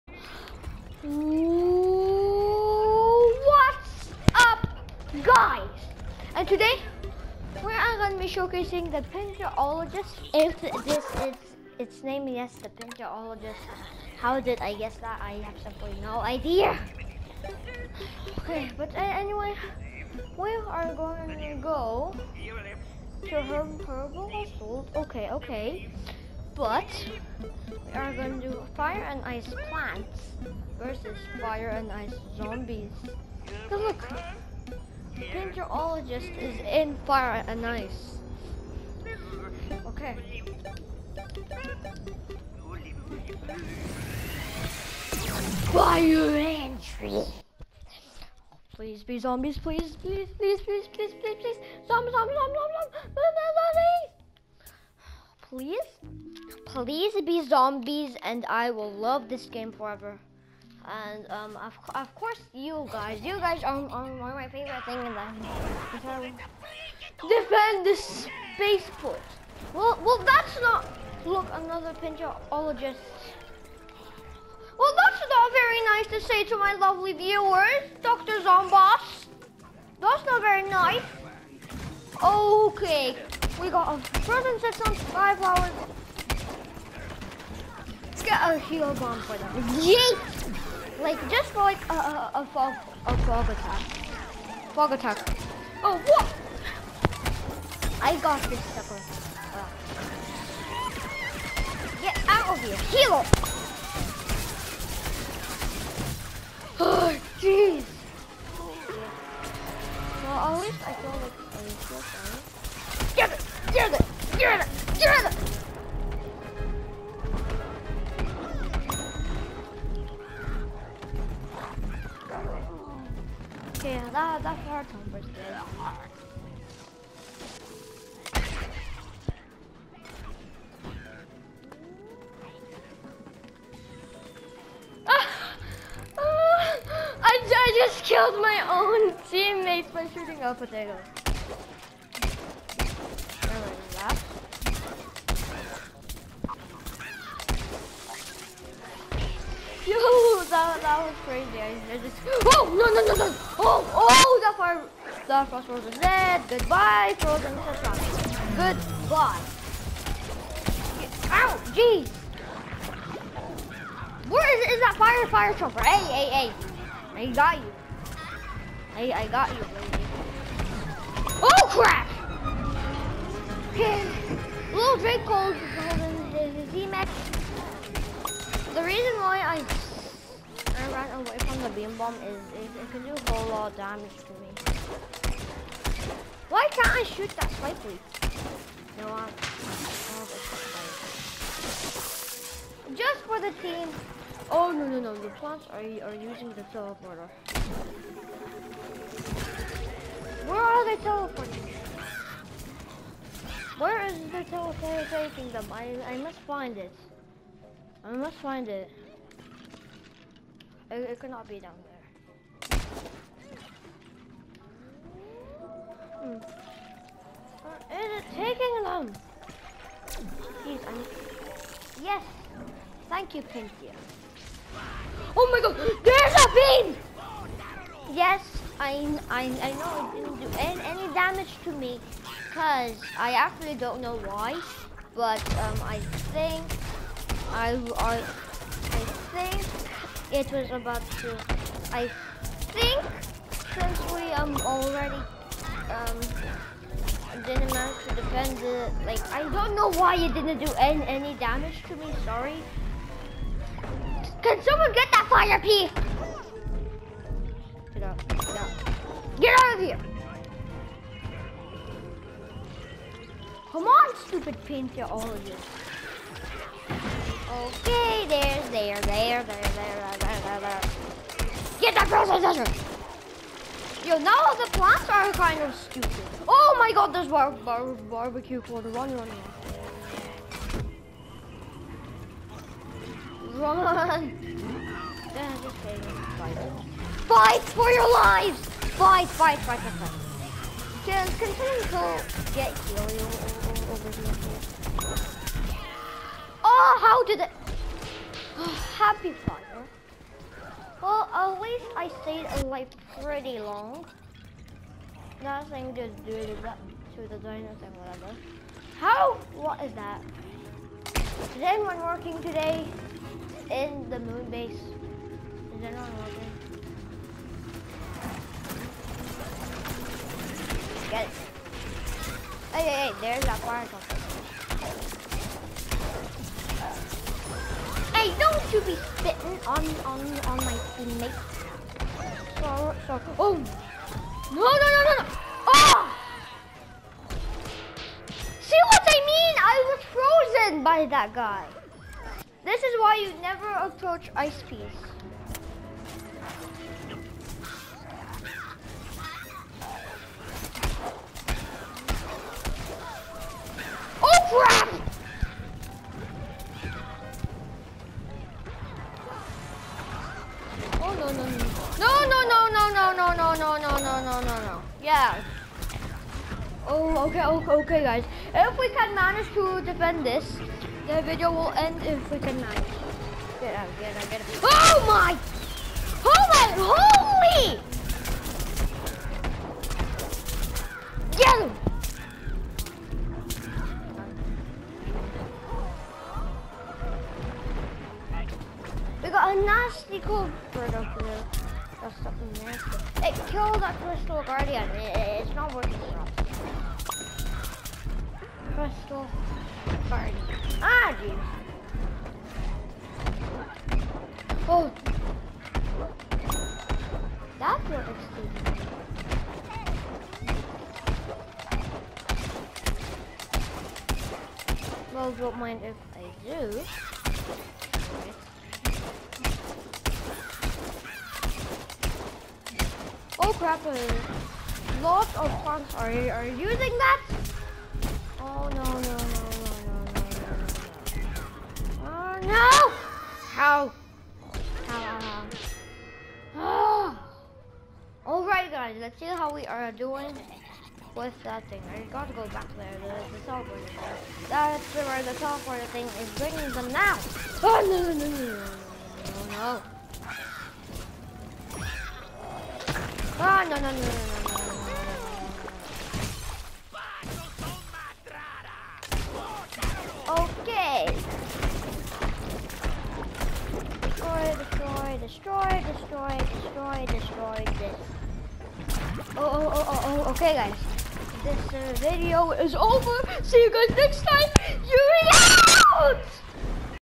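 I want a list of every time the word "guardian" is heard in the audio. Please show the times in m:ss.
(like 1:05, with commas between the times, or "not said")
6:34, 6:40.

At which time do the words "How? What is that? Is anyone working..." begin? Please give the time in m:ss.
5:08.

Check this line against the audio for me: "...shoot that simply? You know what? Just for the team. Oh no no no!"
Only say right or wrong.
wrong.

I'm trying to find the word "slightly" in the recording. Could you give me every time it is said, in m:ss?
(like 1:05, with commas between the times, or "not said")
3:07.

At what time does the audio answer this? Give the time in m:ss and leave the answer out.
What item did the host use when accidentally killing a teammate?
2:20.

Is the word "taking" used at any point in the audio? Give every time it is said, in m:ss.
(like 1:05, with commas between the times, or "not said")
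3:25, 3:38.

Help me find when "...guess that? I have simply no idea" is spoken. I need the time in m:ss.
0:14.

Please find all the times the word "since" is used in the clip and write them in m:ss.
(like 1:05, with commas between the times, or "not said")
4:03.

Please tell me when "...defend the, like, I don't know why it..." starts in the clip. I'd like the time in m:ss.
4:08.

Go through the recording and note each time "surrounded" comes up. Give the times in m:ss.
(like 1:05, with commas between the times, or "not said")
not said.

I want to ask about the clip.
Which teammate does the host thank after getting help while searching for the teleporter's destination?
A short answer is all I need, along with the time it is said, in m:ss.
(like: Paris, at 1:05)
Pinky, at 3:43.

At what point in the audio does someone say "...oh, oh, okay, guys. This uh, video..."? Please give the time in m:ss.
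7:49.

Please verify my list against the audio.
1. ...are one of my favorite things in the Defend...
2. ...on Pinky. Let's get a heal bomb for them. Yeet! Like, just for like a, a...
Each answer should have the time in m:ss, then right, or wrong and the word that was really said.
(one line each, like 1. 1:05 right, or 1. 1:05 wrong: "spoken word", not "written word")
1. 1:03 right
2. 1:24 wrong: "Skywalker", not "Pinky".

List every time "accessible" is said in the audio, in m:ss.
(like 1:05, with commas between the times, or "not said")
not said.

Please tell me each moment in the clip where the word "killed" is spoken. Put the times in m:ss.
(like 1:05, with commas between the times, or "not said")
2:18, 6:33.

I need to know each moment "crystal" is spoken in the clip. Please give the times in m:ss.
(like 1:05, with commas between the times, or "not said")
6:34, 6:38.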